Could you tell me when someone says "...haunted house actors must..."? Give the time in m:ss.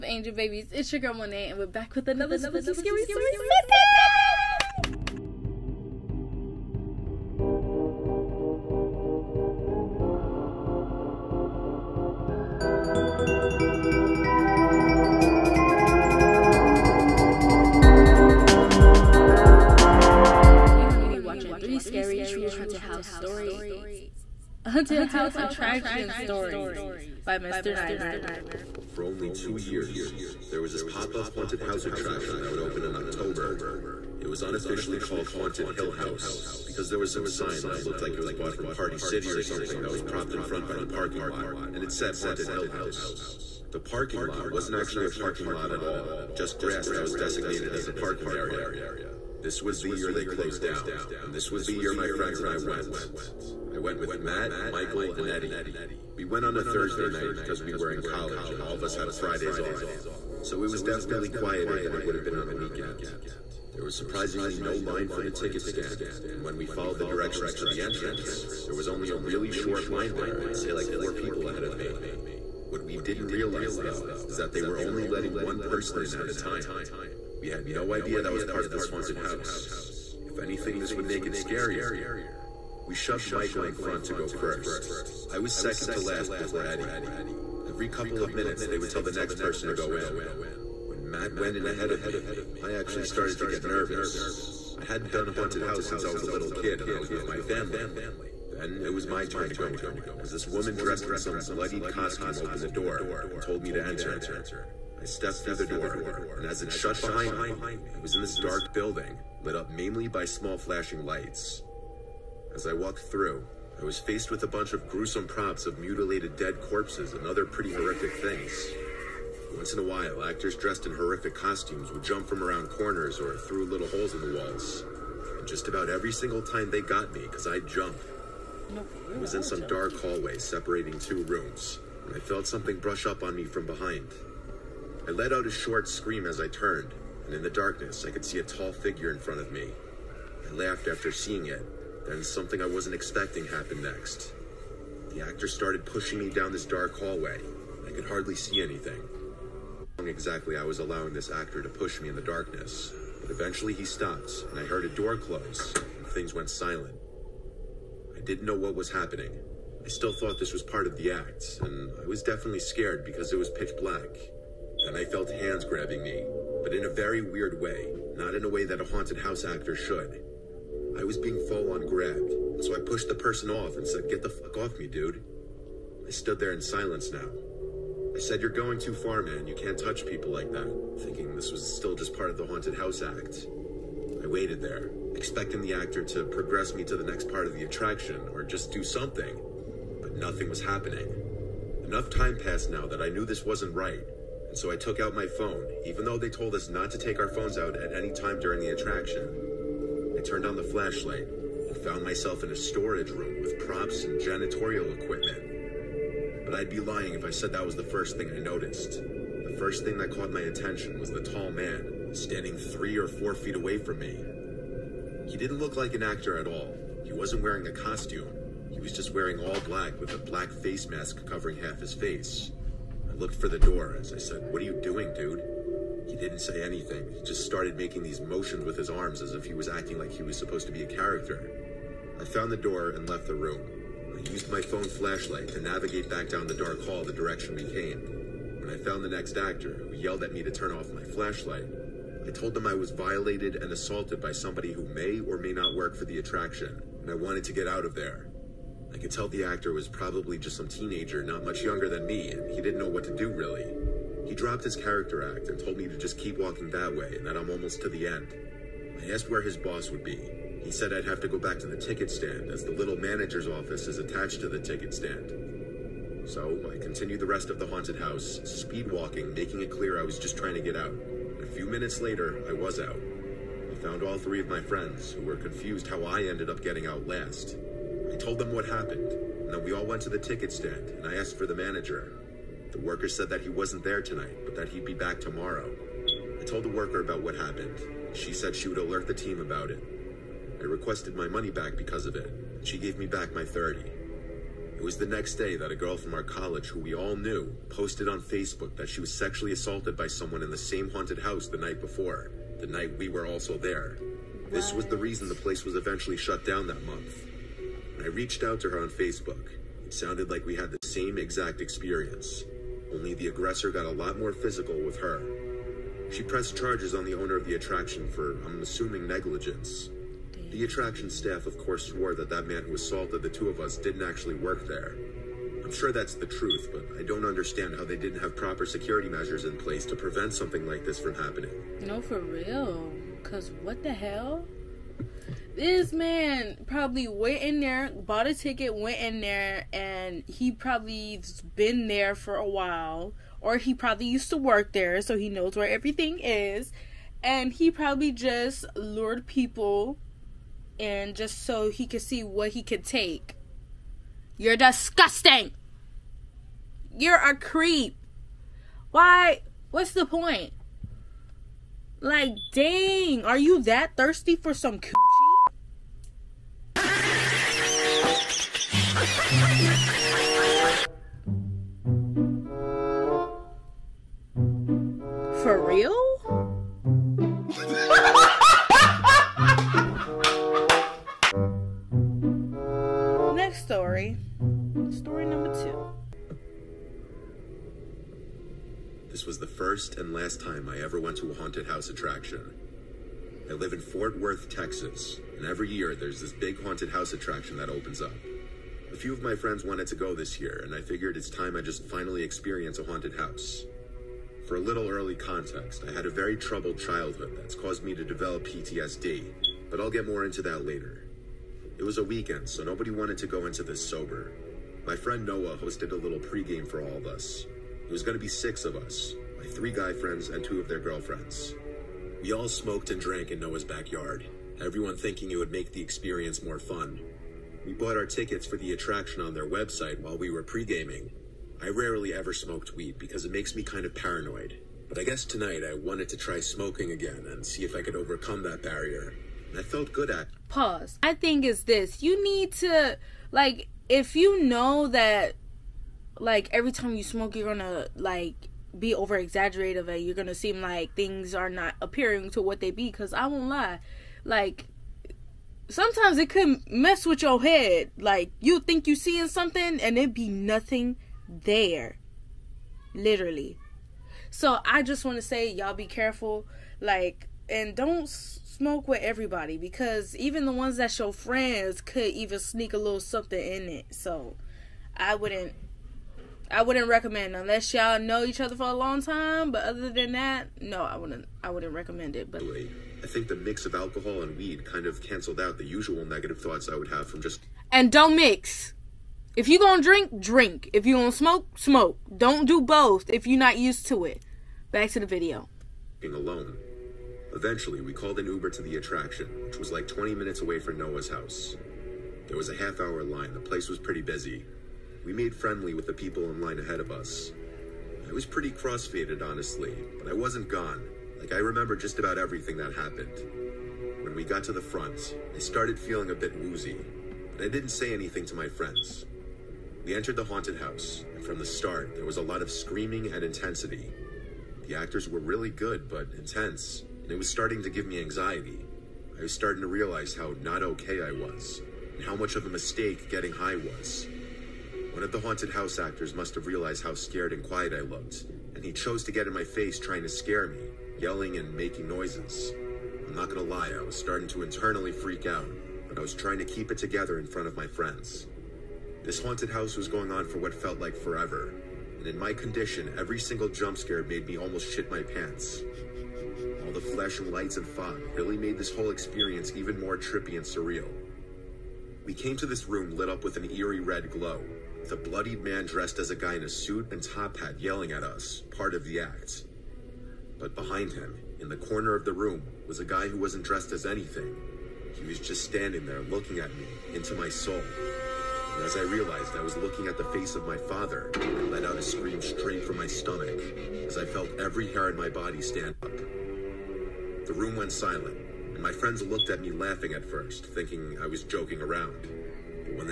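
8:55.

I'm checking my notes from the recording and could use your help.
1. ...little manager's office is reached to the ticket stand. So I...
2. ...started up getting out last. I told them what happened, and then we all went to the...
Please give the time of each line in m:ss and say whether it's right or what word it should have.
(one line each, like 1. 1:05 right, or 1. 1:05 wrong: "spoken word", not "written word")
1. 4:22 wrong: "attached", not "reached"
2. 4:36 wrong: "ended", not "started".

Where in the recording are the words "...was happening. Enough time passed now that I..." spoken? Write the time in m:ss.
3:10.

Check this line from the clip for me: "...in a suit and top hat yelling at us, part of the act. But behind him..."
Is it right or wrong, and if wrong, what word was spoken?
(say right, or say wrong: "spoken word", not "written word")
right.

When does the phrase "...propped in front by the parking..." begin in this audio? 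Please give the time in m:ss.
0:40.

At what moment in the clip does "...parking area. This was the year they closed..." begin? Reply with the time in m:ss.
0:47.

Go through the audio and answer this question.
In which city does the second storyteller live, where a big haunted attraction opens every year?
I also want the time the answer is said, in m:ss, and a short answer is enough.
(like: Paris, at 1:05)
Fort Worth, Texas, at 6:33.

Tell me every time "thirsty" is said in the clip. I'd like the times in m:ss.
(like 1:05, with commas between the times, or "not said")
6:03.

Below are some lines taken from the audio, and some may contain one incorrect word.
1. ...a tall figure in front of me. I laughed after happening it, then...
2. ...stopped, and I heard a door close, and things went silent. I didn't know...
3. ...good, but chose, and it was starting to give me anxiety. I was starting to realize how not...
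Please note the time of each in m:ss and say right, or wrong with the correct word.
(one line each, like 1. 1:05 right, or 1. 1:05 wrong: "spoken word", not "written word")
1. 2:18 wrong: "seeing", not "happening"
2. 2:33 right
3. 8:45 wrong: "intense", not "chose".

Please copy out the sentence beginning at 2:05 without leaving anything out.
And just about every single time they got me, because I'd jump.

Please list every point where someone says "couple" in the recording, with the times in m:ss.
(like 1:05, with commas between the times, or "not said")
1:27.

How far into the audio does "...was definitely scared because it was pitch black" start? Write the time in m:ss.
2:42.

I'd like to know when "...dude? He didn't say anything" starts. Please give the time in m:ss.
3:45.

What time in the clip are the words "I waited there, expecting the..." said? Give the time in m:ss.
3:04.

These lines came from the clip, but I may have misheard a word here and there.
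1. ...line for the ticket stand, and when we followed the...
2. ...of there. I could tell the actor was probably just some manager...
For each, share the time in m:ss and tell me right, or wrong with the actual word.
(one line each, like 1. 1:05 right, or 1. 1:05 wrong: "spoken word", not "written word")
1. 1:04 right
2. 4:07 wrong: "teenager", not "manager".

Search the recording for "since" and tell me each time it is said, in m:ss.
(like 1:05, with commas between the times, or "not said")
1:35.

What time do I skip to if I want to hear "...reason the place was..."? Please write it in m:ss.
5:04.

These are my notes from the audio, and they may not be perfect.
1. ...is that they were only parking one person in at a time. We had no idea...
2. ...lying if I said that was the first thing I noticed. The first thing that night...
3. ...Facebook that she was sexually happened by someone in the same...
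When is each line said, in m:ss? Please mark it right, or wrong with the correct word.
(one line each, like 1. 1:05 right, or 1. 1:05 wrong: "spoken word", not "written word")
1. 1:14 wrong: "letting", not "parking"
2. 3:26 wrong: "caught", not "night"
3. 4:58 wrong: "assaulted", not "happened".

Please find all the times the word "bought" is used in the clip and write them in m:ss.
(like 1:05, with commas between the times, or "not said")
0:38, 5:37, 7:07.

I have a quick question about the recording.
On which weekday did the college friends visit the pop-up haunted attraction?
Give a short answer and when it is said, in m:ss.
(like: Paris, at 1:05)
Thursday, at 0:56.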